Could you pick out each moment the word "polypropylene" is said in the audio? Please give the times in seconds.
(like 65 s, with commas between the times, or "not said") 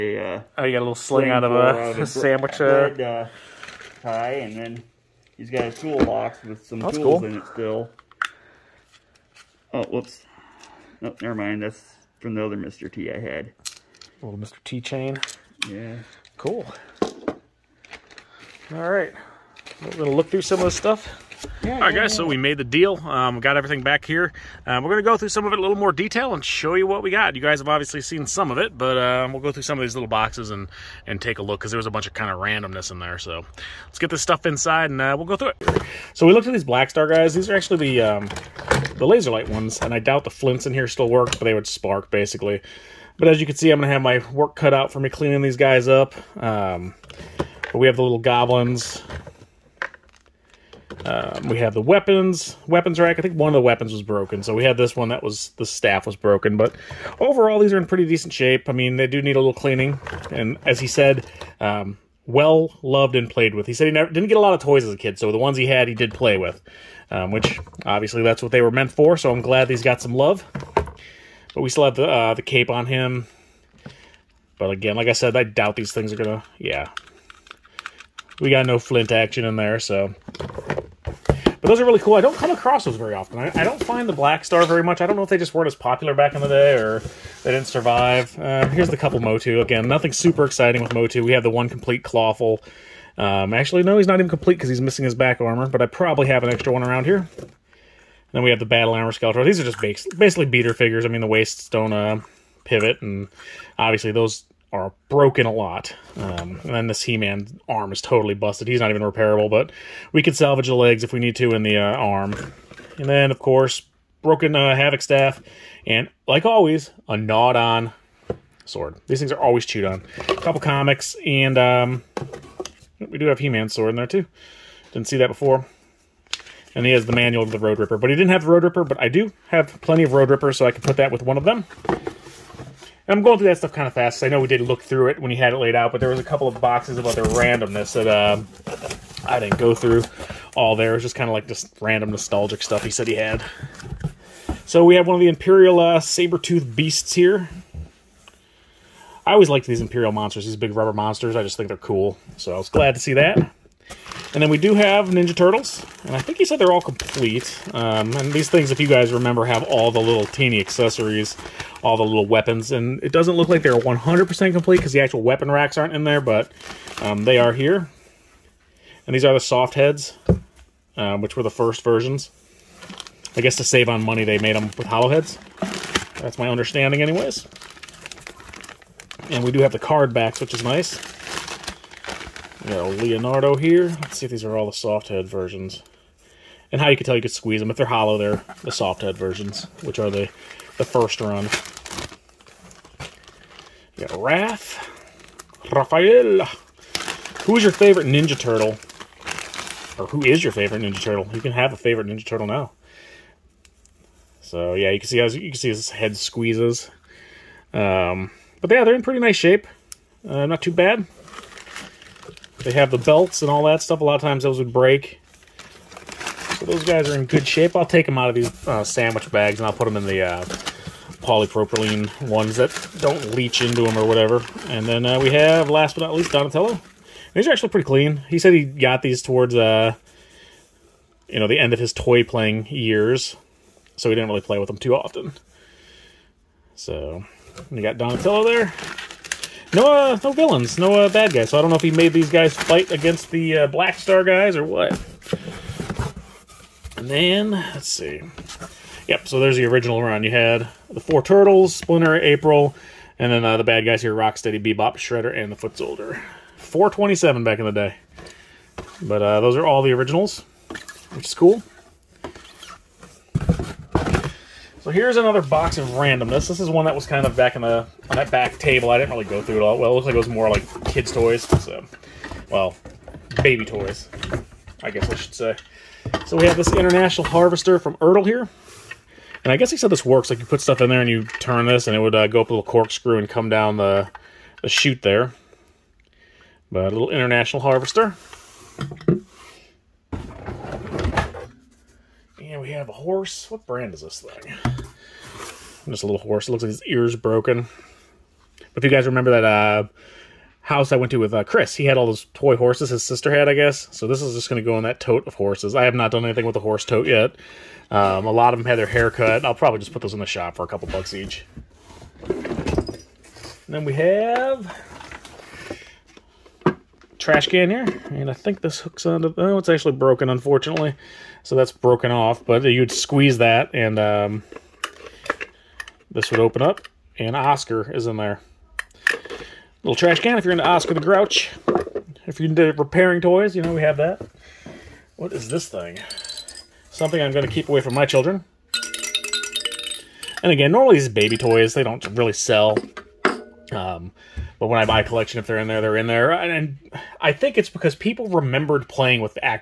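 221 s.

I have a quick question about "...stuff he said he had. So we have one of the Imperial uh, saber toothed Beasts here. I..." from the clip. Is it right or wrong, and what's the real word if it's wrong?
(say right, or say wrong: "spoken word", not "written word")
right.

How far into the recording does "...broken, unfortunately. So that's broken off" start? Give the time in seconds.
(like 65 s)
319 s.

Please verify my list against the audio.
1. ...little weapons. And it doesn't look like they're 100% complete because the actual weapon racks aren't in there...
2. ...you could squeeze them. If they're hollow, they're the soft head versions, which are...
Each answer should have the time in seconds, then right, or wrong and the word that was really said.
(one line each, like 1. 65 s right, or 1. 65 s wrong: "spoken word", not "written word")
1. 162 s right
2. 187 s right.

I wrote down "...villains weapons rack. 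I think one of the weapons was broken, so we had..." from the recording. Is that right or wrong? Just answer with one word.
wrong.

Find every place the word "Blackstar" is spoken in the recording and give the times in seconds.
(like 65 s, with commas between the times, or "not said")
36 s, 84 s, 243 s.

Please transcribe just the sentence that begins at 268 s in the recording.
I didn't really go through it all.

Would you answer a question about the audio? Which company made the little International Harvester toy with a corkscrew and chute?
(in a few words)
Ertl.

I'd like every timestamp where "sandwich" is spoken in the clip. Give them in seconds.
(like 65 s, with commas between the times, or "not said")
2 s, 218 s.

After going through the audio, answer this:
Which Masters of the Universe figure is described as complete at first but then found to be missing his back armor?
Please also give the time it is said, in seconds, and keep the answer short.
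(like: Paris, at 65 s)
Clawful, at 92 s.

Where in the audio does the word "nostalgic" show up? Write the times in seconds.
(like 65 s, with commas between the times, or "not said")
142 s.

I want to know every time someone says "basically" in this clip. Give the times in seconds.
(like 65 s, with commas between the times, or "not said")
42 s, 99 s.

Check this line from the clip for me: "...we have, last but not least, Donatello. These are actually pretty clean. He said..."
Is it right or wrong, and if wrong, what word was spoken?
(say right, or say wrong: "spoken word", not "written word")
right.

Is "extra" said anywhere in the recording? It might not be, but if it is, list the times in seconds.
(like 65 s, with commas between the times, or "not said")
96 s.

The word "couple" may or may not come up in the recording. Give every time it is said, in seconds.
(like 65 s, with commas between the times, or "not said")
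88 s, 120 s, 136 s, 310 s.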